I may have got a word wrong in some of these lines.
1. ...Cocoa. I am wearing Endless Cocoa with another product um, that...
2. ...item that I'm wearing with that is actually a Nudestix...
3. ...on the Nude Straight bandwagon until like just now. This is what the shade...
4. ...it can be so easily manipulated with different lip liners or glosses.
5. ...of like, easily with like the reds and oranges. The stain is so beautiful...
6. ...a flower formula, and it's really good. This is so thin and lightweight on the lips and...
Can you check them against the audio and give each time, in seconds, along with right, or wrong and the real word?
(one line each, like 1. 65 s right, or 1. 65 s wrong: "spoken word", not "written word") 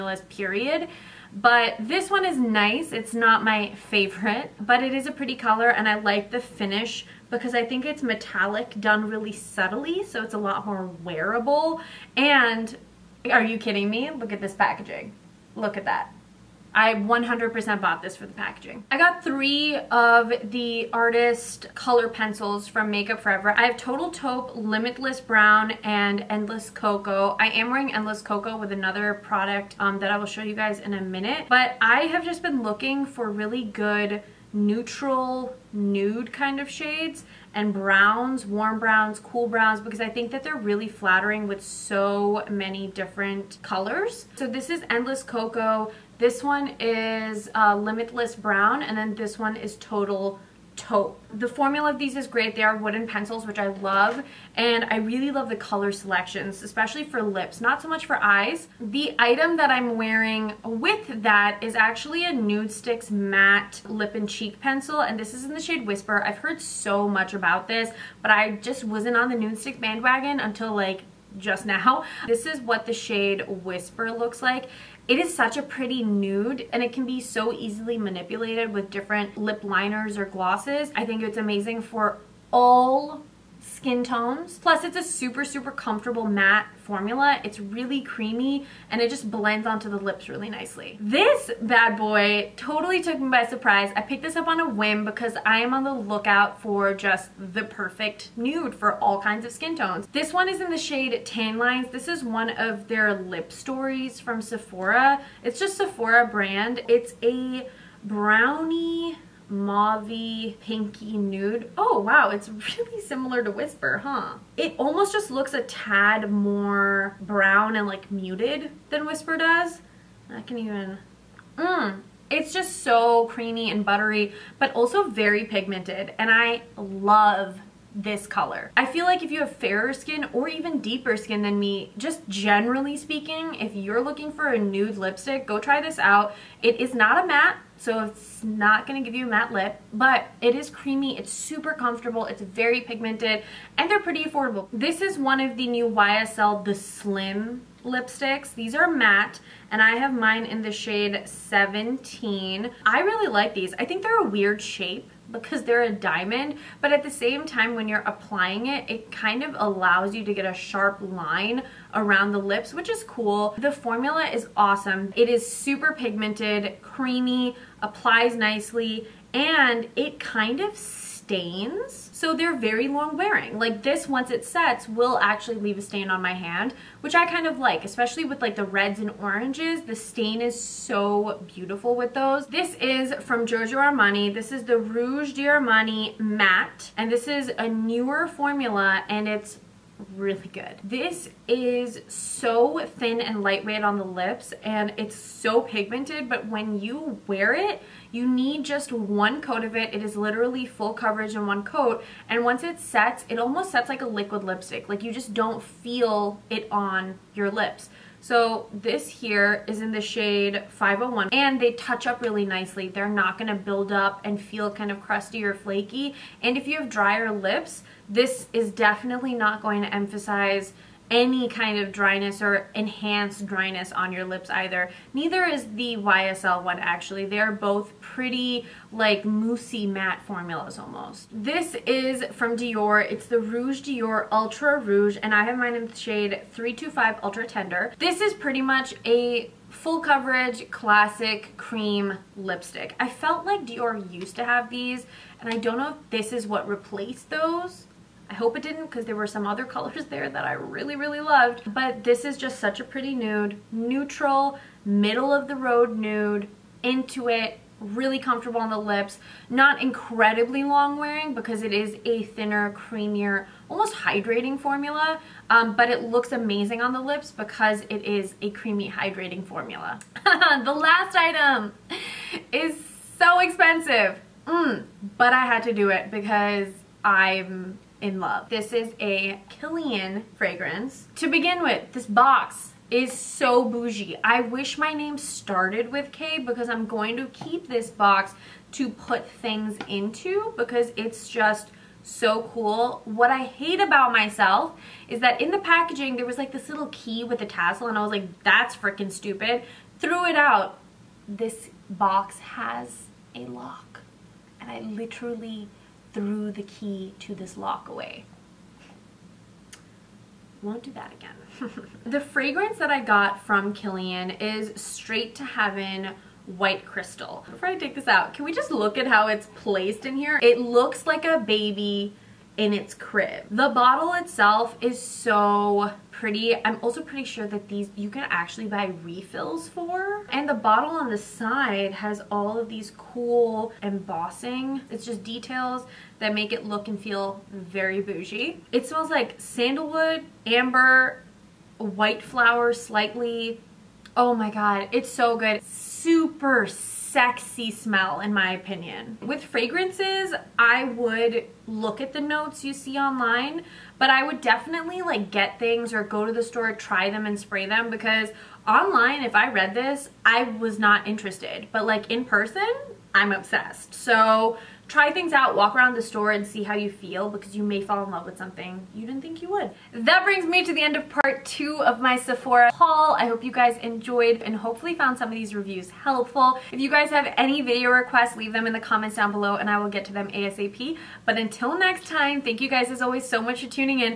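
1. 26 s right
2. 59 s right
3. 69 s wrong: "Stick", not "Straight"
4. 76 s right
5. 177 s wrong: "especially", not "easily"
6. 187 s wrong: "newer", not "flower".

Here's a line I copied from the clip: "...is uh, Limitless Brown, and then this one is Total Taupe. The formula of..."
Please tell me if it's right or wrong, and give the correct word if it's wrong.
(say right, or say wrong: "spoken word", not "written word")
right.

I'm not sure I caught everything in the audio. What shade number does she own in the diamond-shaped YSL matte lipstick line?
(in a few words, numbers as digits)
17.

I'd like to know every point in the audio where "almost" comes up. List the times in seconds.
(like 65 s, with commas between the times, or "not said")
114 s, 203 s, 230 s, 263 s.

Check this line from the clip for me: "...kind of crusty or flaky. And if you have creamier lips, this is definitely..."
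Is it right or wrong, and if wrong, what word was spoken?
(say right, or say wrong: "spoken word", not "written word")
wrong: "drier", not "creamier".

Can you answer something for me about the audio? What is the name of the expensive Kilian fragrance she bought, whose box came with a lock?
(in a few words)
Straight to Heaven.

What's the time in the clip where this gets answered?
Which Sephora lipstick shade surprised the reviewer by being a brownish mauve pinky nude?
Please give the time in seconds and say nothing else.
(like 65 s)
101 s.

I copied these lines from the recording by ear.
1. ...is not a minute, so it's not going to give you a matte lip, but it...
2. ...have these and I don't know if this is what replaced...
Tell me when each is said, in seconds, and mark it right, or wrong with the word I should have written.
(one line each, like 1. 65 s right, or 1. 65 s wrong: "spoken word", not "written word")
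1. 136 s wrong: "matte", not "minute"
2. 244 s right.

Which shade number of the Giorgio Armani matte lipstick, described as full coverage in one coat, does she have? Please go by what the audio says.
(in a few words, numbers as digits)
501.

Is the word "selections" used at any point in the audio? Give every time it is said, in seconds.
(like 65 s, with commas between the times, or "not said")
55 s.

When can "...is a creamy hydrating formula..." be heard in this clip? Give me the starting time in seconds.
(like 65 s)
268 s.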